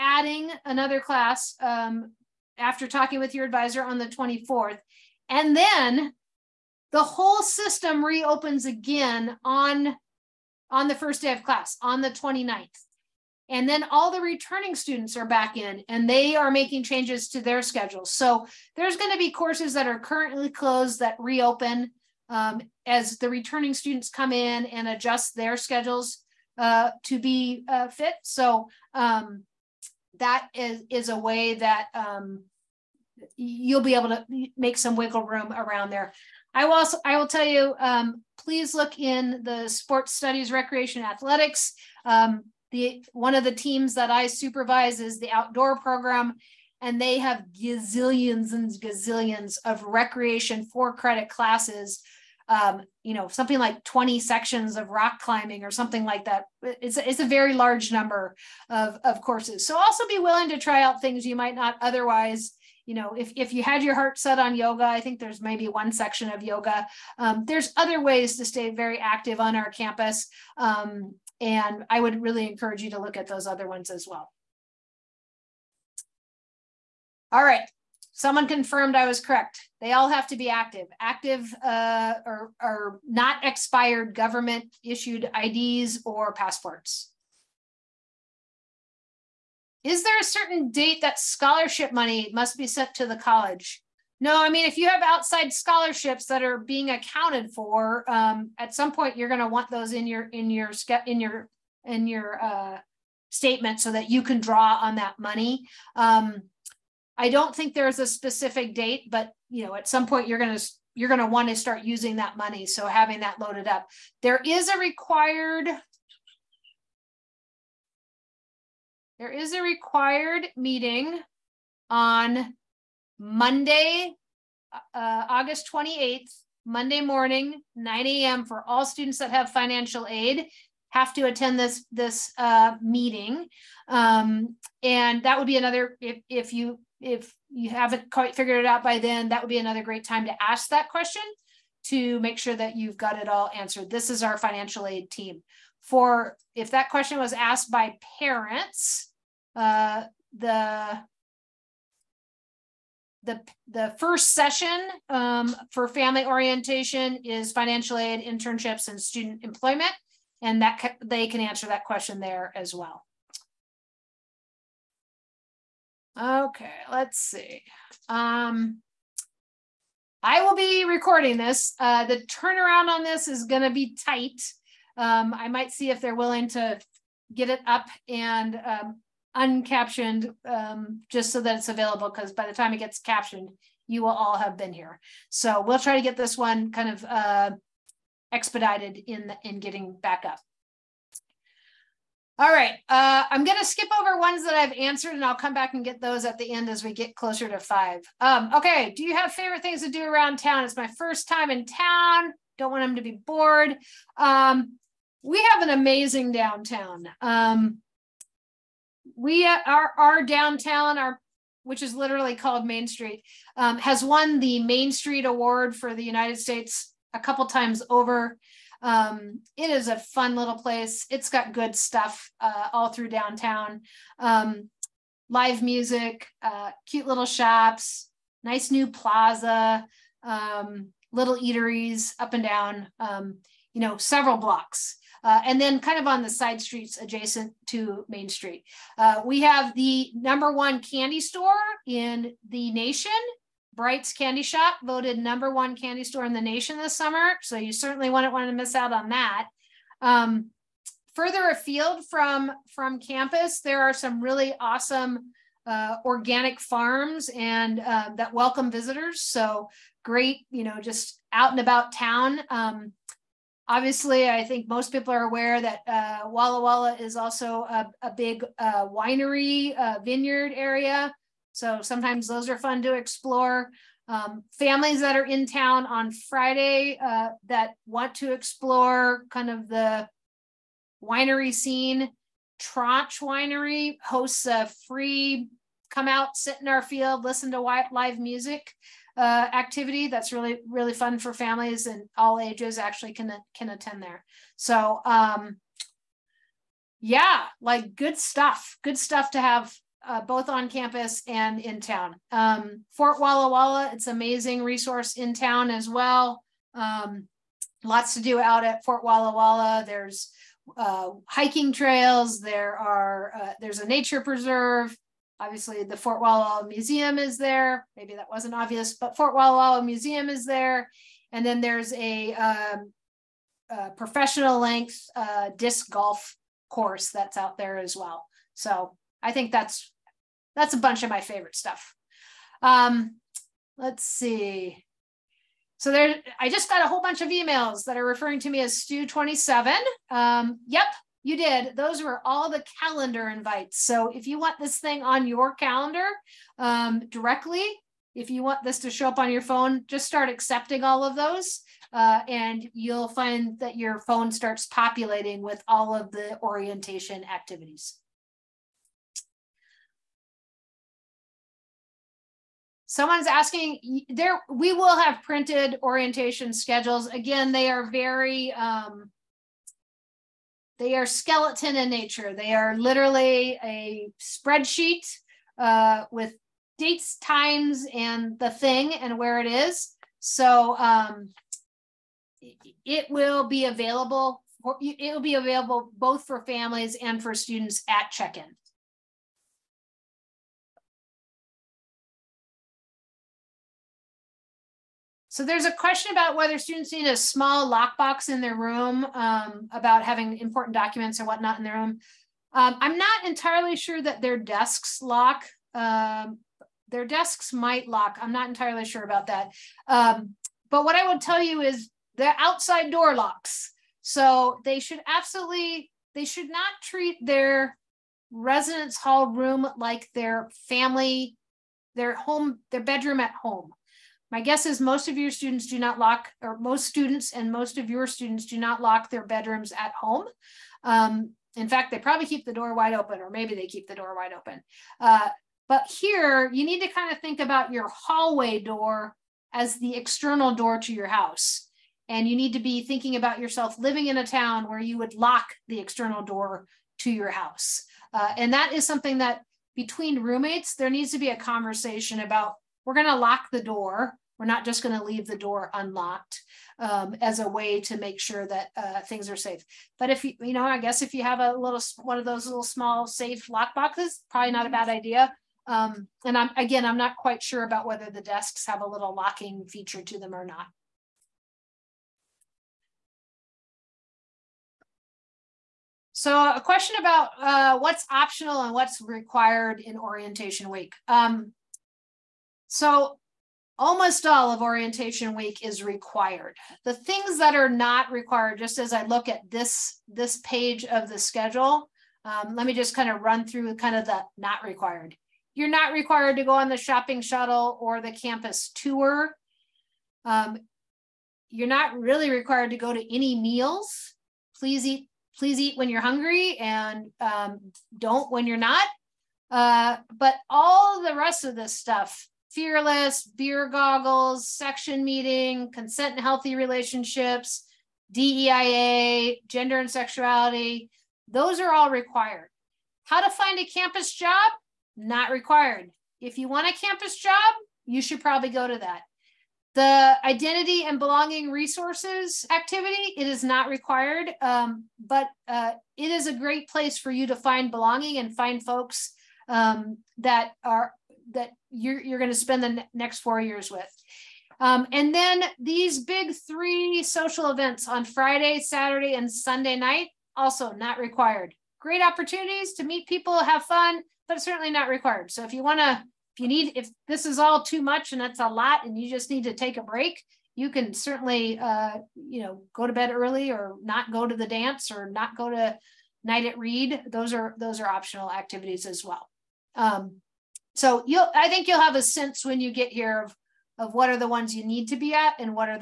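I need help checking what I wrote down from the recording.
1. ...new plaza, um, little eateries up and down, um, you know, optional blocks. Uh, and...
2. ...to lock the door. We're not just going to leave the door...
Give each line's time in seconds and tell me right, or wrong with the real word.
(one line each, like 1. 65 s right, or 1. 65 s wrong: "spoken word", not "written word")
1. 228 s wrong: "several", not "optional"
2. 453 s right.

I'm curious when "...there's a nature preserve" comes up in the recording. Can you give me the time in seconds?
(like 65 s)
313 s.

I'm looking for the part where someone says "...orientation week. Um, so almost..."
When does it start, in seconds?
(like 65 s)
479 s.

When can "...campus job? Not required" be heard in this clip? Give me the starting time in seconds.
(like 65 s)
523 s.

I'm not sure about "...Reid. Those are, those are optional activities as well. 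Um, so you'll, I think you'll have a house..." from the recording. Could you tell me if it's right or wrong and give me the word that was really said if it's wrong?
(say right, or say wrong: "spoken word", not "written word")
wrong: "sense", not "house".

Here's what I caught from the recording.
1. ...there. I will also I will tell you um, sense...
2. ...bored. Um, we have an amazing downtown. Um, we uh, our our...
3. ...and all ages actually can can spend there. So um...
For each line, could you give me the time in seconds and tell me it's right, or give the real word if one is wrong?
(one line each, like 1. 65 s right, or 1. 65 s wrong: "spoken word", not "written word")
1. 35 s wrong: "please", not "sense"
2. 203 s right
3. 291 s wrong: "attend", not "spend".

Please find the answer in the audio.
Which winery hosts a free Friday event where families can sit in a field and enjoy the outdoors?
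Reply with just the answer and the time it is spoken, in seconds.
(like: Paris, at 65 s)
Tranche Winery, at 282 s.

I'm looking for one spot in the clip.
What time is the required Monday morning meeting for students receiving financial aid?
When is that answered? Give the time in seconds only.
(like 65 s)
127 s.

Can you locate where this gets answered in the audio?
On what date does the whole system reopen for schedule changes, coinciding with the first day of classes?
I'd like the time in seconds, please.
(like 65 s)
12 s.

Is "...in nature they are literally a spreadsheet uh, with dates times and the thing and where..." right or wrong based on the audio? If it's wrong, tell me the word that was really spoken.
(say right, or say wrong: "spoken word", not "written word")
right.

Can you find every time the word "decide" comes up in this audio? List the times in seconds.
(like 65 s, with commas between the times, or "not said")
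not said.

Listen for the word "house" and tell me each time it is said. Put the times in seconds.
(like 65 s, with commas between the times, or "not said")
441 s, 447 s.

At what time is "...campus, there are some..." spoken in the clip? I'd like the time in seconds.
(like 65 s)
252 s.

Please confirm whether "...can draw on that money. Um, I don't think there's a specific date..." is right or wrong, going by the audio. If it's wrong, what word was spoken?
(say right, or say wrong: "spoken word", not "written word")
right.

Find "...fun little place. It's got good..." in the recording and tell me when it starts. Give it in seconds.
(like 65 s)
219 s.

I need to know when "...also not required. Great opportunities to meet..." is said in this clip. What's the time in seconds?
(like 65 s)
550 s.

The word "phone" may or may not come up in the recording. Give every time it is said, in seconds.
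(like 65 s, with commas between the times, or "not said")
349 s, 354 s.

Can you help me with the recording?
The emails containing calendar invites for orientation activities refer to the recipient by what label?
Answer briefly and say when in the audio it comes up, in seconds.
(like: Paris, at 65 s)
Stu 27, at 338 s.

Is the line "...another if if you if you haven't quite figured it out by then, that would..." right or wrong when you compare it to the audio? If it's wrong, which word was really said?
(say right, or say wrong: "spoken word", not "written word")
right.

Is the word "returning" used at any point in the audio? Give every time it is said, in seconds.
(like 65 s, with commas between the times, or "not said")
14 s, 23 s.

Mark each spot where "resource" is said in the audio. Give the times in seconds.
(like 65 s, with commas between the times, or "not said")
304 s, 531 s.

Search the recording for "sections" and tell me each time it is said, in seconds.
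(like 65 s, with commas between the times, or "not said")
54 s, 65 s, 514 s.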